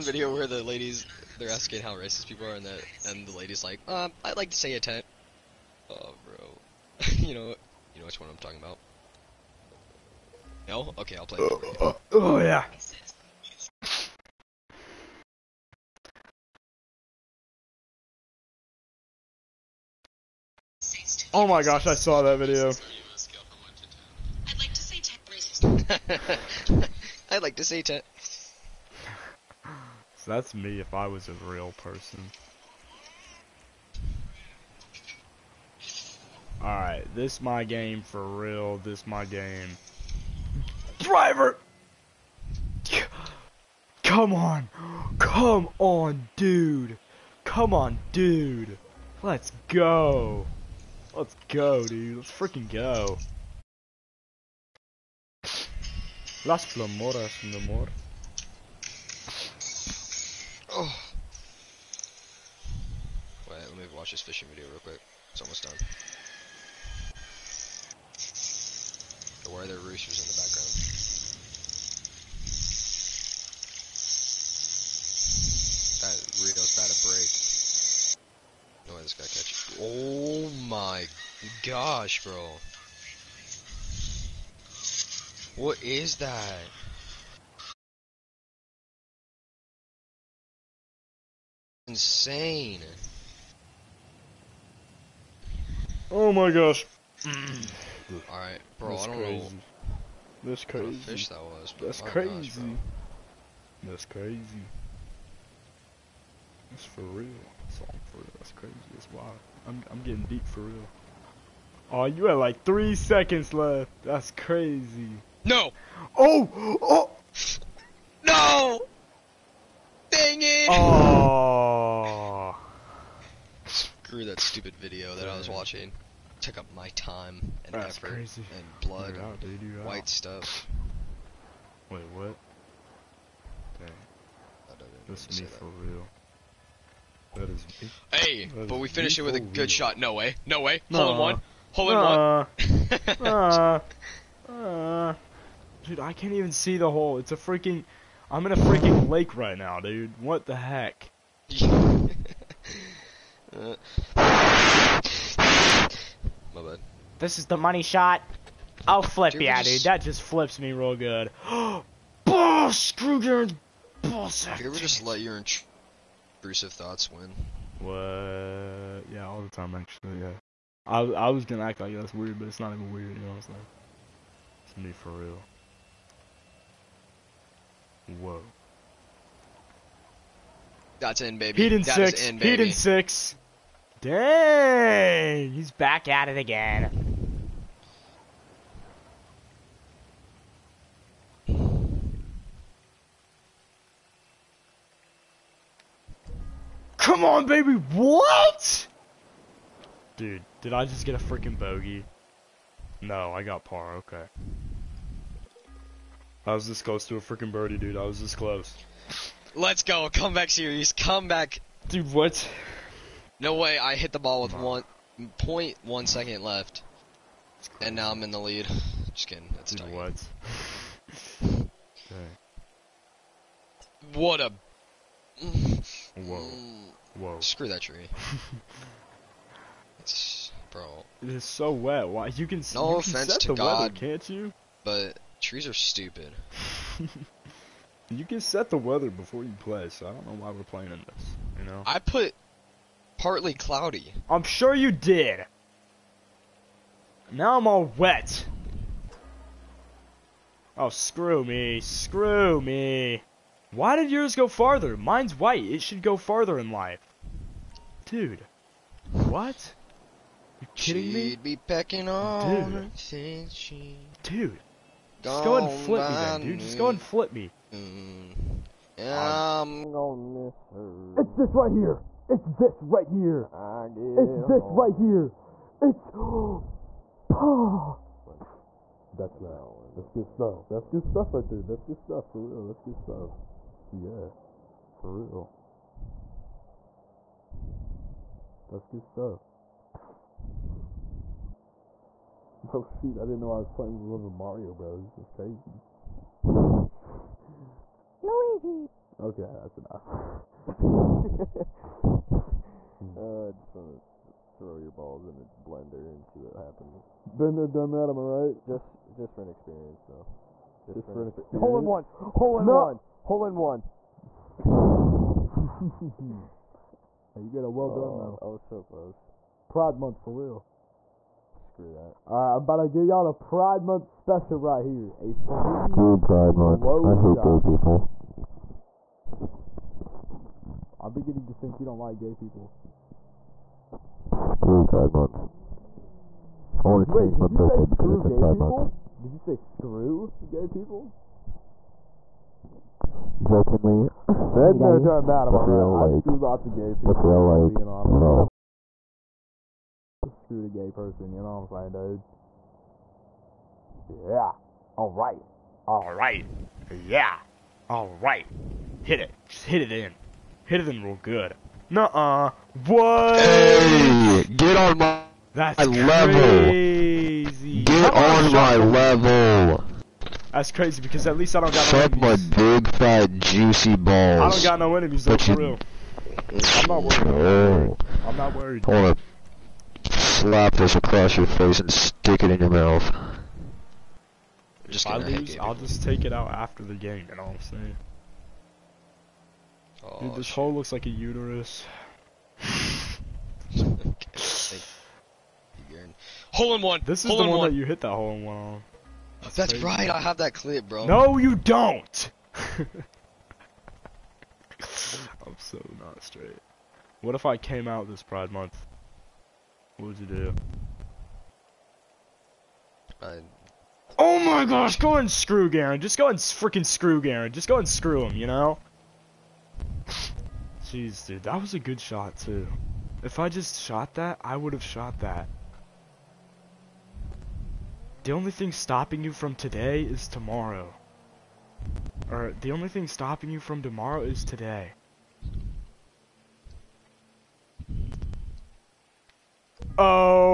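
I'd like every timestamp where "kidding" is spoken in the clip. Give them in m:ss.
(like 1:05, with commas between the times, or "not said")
3:39, 4:20.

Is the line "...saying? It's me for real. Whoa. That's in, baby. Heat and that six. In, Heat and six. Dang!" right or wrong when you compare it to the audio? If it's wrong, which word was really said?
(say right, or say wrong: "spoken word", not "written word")
right.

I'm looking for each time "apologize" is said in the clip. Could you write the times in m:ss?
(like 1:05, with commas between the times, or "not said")
not said.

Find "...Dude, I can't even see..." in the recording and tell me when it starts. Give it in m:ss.
2:25.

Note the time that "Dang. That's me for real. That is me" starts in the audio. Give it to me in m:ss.
2:13.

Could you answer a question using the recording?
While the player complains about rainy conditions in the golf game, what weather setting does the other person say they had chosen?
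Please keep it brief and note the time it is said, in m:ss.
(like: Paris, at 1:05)
Partly cloudy, at 4:03.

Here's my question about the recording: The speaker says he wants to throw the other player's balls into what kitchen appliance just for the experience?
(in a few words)
Blender.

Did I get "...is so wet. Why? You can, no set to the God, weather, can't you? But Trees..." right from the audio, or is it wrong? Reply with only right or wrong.
right.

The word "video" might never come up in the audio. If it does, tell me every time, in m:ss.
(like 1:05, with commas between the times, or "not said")
0:00, 0:22, 1:04, 2:04.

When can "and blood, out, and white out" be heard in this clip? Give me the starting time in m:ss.
2:08.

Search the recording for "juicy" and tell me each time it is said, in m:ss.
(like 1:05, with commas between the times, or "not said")
6:13.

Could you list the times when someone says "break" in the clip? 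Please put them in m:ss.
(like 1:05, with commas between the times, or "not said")
1:18.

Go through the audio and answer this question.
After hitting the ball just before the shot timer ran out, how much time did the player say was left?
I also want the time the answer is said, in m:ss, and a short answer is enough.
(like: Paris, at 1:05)
1.1 seconds, at 3:34.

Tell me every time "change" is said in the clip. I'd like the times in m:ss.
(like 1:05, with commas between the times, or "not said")
5:37.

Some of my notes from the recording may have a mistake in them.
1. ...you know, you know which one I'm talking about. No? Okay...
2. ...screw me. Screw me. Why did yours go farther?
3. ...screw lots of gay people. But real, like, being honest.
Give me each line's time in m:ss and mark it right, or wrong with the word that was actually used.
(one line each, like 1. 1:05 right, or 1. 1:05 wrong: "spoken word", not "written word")
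1. 0:07 right
2. 4:10 right
3. 5:46 right.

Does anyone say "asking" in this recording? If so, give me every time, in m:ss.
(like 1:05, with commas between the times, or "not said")
0:01.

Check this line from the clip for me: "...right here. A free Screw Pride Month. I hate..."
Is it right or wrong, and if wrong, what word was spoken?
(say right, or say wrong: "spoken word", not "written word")
right.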